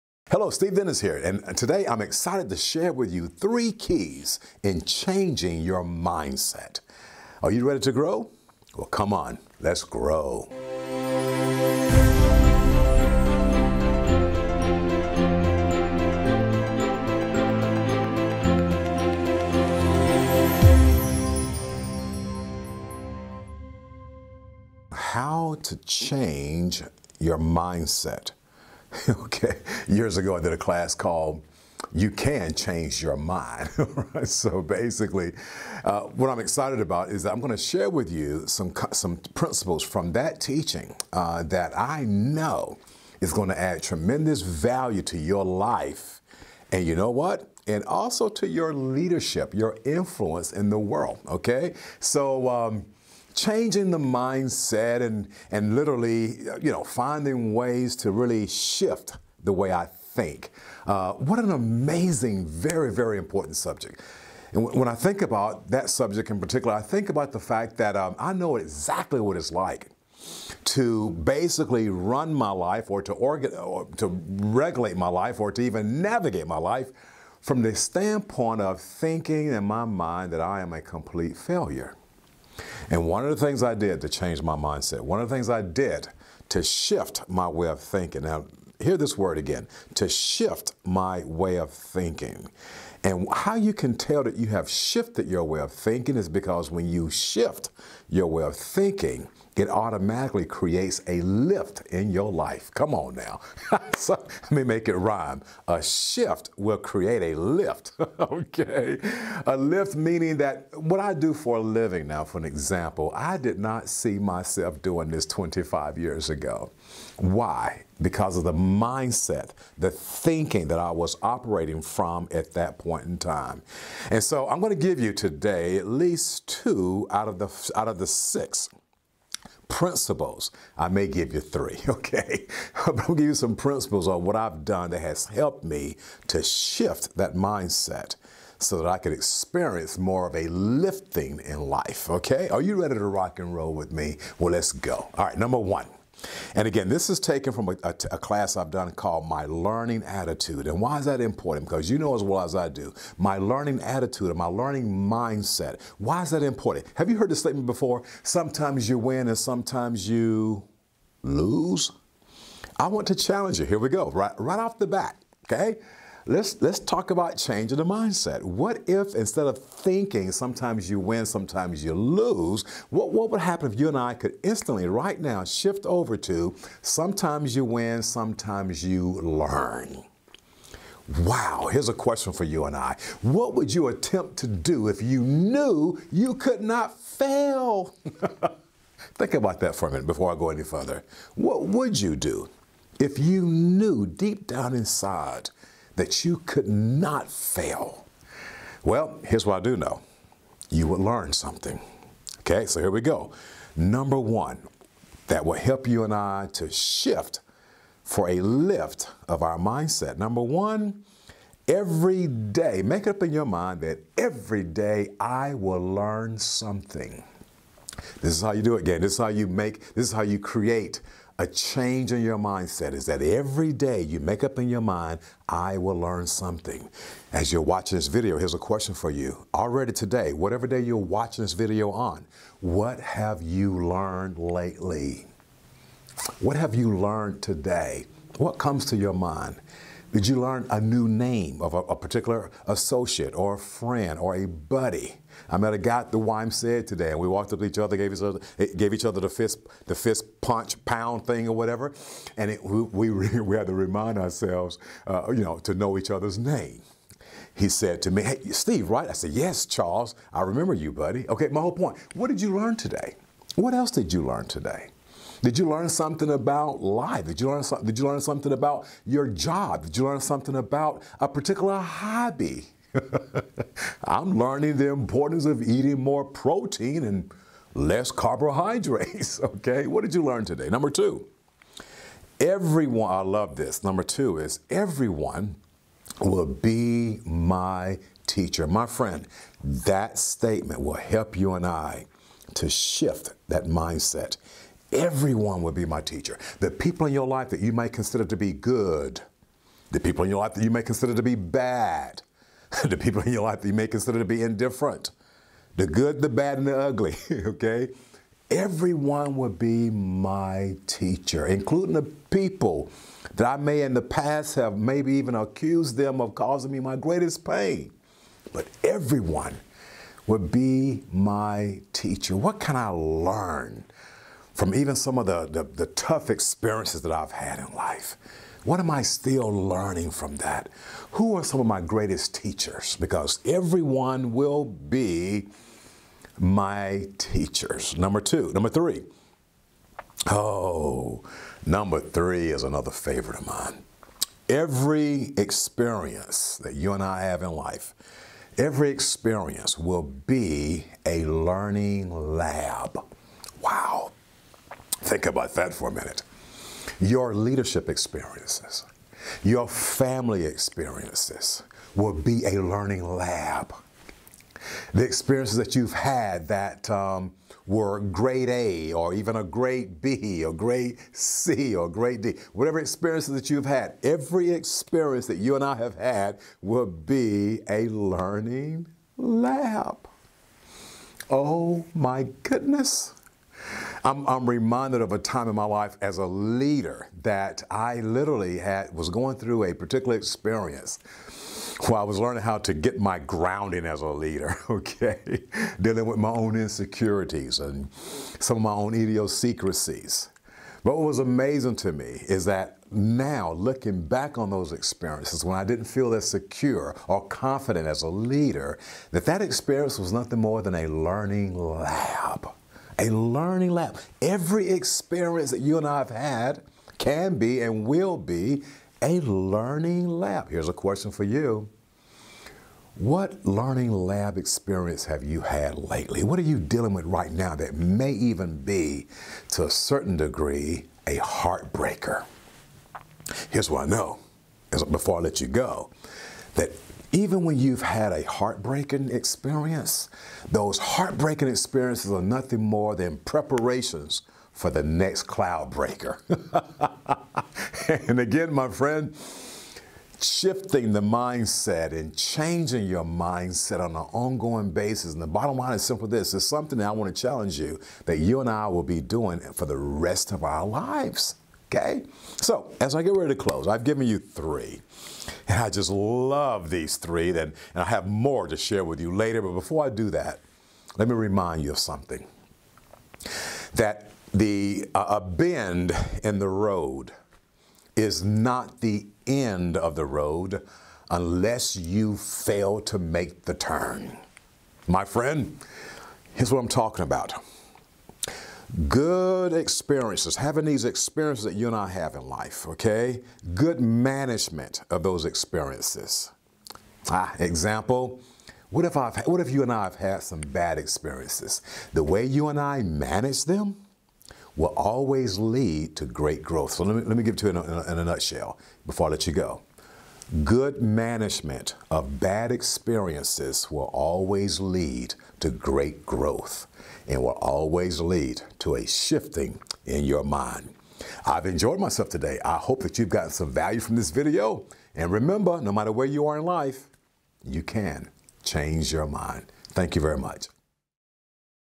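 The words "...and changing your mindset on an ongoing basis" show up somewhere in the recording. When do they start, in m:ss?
7:31.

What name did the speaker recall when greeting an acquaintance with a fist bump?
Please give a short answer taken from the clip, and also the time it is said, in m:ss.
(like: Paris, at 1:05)
Charles, at 4:19.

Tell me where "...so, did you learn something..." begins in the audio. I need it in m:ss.
4:27.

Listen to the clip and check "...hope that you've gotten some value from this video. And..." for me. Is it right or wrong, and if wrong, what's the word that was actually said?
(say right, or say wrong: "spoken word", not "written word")
right.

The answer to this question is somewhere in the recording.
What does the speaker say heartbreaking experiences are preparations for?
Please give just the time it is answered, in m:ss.
7:25.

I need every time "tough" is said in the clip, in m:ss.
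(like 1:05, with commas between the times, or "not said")
5:25.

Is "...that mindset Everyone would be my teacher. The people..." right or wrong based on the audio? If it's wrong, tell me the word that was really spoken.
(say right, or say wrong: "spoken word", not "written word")
right.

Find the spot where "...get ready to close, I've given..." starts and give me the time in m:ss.
7:43.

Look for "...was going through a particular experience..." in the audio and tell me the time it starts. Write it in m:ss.
6:28.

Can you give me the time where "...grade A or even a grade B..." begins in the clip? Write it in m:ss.
6:07.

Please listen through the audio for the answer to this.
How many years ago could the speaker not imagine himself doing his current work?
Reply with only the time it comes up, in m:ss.
1:55.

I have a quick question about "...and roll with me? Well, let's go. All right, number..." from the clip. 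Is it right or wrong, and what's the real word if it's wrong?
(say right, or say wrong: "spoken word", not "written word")
right.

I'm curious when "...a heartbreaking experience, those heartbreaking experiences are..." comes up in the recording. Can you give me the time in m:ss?
7:18.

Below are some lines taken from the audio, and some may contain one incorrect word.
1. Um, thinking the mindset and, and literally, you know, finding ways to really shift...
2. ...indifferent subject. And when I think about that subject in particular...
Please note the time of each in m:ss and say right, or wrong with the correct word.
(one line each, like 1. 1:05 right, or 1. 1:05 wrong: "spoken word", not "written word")
1. 0:52 wrong: "changing", not "thinking"
2. 1:03 wrong: "important", not "indifferent".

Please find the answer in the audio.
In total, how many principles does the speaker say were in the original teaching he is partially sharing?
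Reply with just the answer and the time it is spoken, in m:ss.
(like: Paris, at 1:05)
6, at 2:08.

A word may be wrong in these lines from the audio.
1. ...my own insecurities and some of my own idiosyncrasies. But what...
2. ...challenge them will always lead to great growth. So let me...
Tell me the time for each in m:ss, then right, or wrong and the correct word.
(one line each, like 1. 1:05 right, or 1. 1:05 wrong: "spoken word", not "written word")
1. 6:36 right
2. 8:22 wrong: "manage", not "challenge".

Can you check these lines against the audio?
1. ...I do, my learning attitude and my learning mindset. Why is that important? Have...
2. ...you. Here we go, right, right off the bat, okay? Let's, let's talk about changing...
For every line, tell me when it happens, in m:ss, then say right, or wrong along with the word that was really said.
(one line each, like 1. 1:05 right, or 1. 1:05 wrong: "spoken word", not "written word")
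1. 2:32 right
2. 2:43 right.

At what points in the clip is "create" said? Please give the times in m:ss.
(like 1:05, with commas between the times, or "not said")
1:40, 1:46, 3:40.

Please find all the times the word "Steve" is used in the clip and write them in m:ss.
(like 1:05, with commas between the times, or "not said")
0:00, 4:18.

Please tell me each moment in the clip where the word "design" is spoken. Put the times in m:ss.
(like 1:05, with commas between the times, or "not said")
not said.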